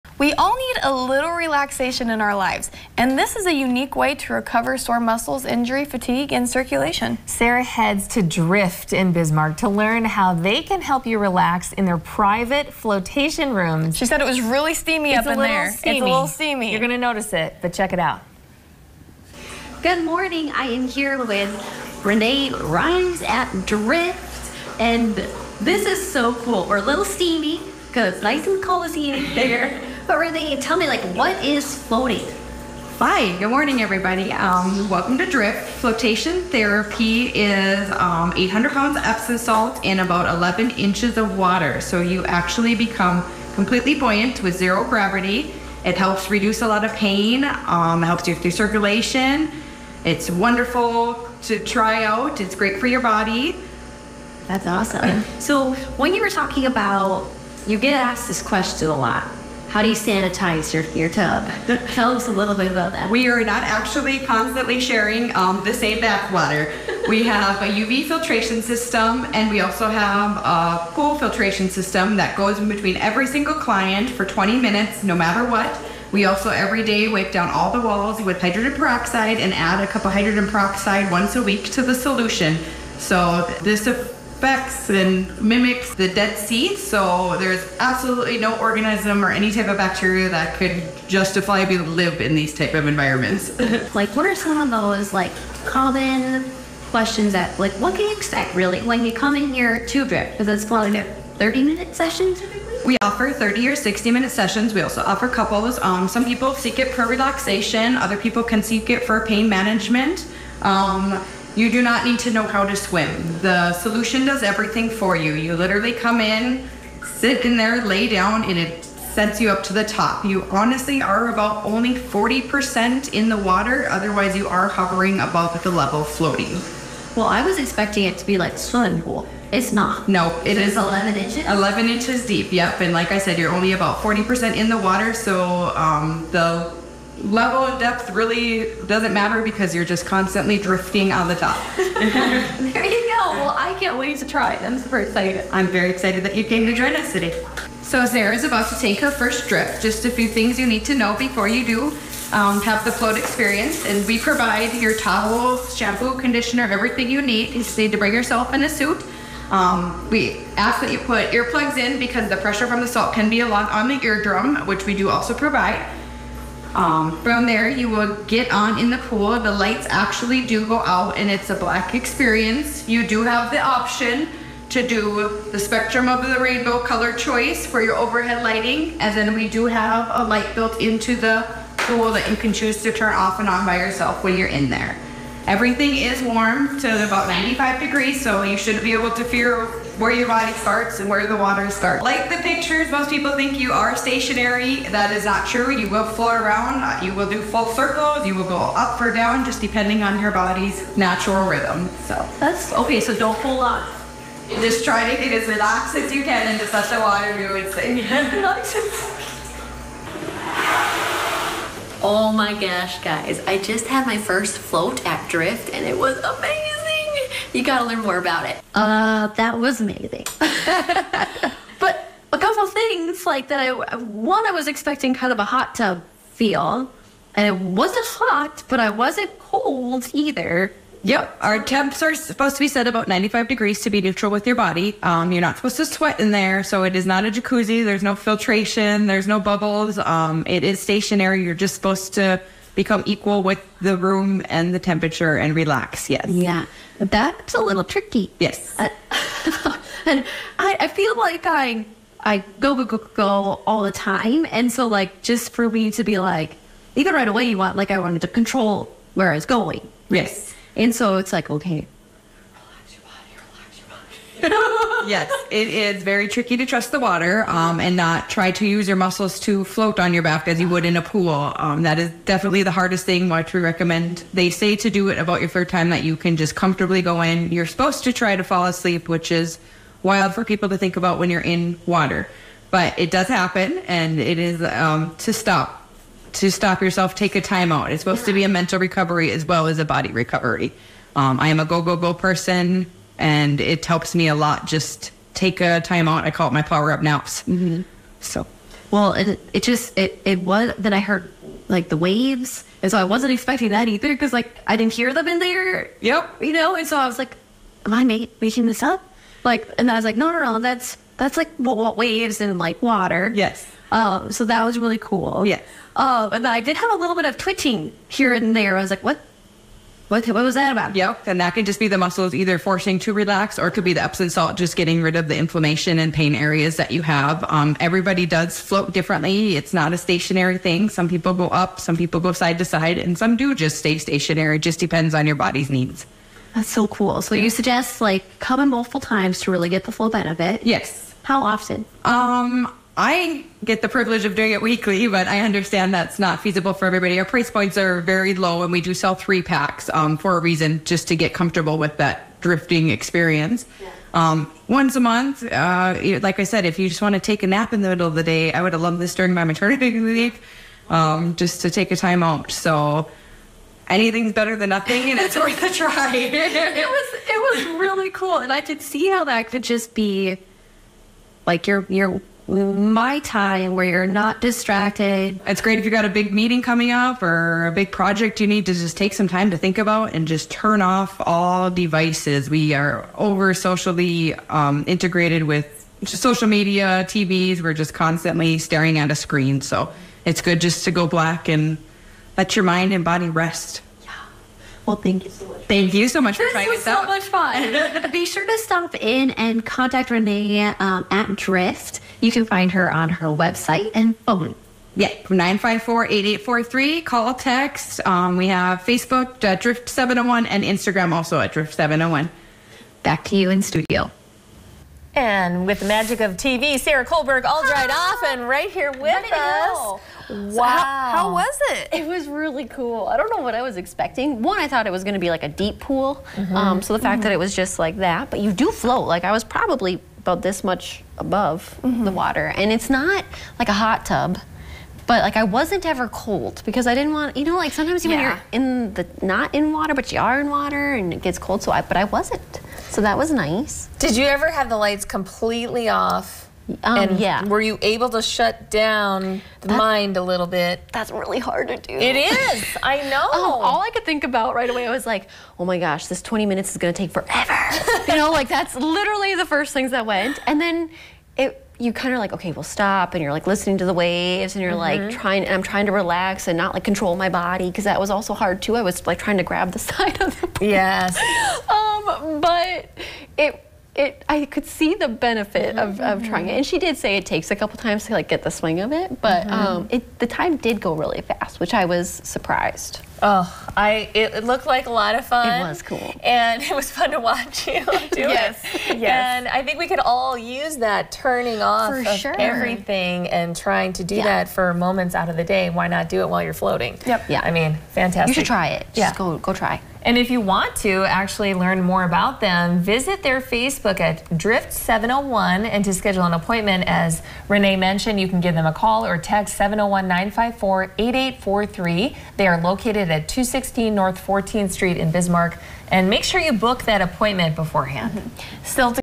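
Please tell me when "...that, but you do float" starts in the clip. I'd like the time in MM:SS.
07:07.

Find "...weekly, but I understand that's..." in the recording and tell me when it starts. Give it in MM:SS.
05:44.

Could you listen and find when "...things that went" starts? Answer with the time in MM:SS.
07:39.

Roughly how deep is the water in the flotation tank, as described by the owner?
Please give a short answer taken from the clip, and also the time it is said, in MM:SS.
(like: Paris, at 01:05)
11 inches, at 00:40.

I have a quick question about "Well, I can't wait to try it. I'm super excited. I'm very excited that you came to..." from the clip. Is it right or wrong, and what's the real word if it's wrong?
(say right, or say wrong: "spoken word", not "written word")
right.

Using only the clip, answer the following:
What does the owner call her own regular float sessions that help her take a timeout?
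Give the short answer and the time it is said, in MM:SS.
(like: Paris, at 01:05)
Power up naps, at 04:56.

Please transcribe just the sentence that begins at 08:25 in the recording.
And to schedule an appointment, as Renee mentioned, you can give them a call or text 701 954 8843.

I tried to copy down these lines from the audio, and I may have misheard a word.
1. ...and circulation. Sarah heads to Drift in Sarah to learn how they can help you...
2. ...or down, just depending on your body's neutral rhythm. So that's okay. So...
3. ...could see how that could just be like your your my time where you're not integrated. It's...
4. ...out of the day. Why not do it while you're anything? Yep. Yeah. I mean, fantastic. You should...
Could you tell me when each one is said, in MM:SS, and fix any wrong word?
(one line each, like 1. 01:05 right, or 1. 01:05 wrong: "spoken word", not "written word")
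1. 00:06 wrong: "Bismarck", not "Sarah"
2. 03:18 wrong: "natural", not "neutral"
3. 06:08 wrong: "distracted", not "integrated"
4. 08:15 wrong: "floating", not "anything".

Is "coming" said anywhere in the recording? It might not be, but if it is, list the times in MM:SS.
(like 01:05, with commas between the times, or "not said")
05:38, 06:16.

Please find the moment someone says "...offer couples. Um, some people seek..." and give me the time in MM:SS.
01:45.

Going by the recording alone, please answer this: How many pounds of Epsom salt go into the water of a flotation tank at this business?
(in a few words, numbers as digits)
800.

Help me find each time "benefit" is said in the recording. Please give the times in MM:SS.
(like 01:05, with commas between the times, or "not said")
05:40, 07:55.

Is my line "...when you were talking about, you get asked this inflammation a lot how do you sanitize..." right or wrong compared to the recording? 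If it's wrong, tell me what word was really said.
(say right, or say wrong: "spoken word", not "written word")
wrong: "question", not "inflammation".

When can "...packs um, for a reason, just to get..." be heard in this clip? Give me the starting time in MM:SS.
05:49.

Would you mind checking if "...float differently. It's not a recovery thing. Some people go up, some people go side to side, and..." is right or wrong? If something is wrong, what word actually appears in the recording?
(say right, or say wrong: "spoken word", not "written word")
wrong: "stationary", not "recovery".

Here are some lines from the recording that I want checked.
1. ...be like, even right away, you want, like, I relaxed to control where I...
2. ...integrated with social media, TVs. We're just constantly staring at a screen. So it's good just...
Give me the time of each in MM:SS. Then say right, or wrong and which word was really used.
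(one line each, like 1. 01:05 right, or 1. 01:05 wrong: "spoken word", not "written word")
1. 04:16 wrong: "wanted", not "relaxed"
2. 06:24 right.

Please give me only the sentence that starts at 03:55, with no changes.
Um, you're not supposed to sweat in there, so it is not a jacuzzi.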